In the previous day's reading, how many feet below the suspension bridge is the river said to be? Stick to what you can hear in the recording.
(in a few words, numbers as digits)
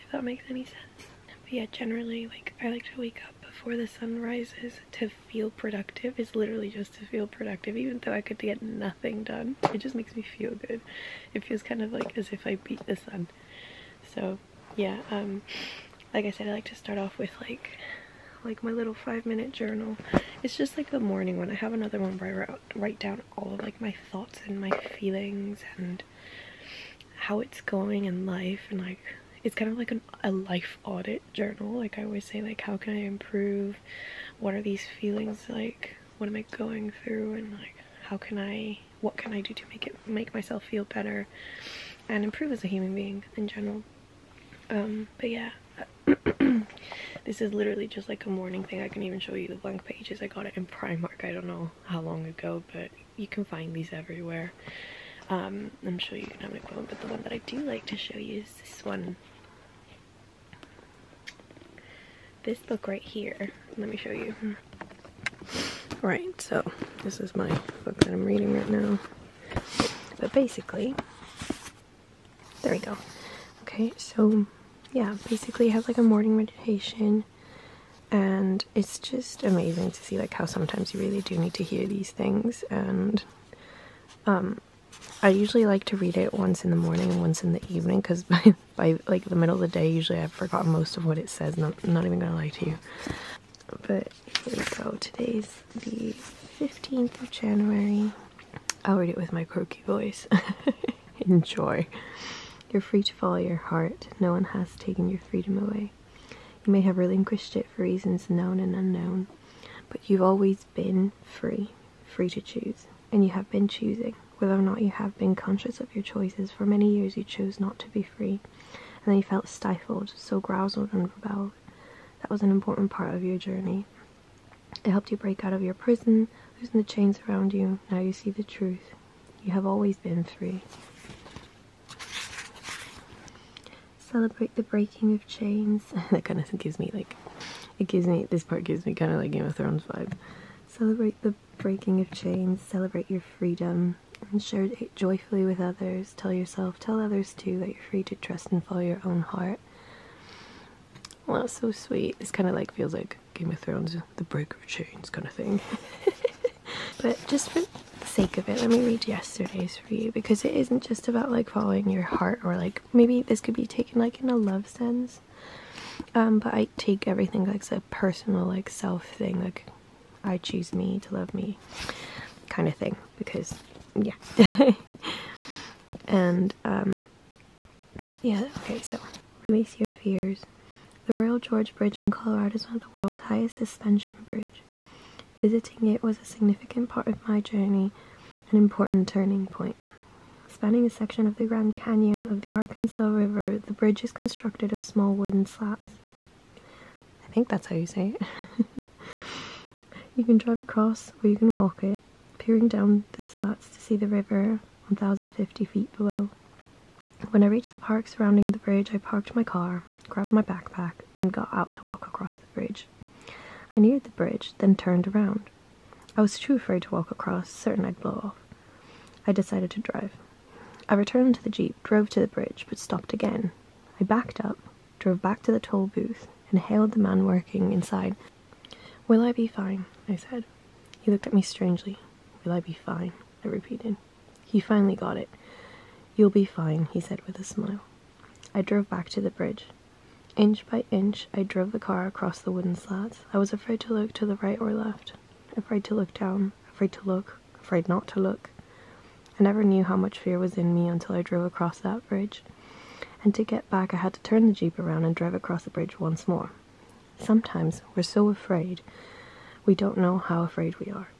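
1,050 feet.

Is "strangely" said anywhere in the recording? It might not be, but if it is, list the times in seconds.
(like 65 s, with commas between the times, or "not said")
231 s.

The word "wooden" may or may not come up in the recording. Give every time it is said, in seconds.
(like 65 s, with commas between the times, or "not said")
195 s, 242 s.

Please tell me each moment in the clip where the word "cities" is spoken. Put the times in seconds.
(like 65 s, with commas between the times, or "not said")
not said.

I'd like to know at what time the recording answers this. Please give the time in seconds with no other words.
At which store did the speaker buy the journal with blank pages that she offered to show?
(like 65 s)
50 s.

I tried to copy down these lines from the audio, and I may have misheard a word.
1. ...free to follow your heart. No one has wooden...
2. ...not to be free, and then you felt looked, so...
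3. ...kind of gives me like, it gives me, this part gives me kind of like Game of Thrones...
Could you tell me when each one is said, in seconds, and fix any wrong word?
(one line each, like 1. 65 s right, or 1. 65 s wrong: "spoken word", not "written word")
1. 102 s wrong: "taken", not "wooden"
2. 117 s wrong: "stifled", not "looked"
3. 136 s right.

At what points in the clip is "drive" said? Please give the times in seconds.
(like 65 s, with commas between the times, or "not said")
200 s, 219 s, 255 s.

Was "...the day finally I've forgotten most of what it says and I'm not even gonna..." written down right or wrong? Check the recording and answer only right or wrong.
wrong.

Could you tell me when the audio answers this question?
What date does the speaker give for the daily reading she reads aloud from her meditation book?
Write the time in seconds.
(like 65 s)
96 s.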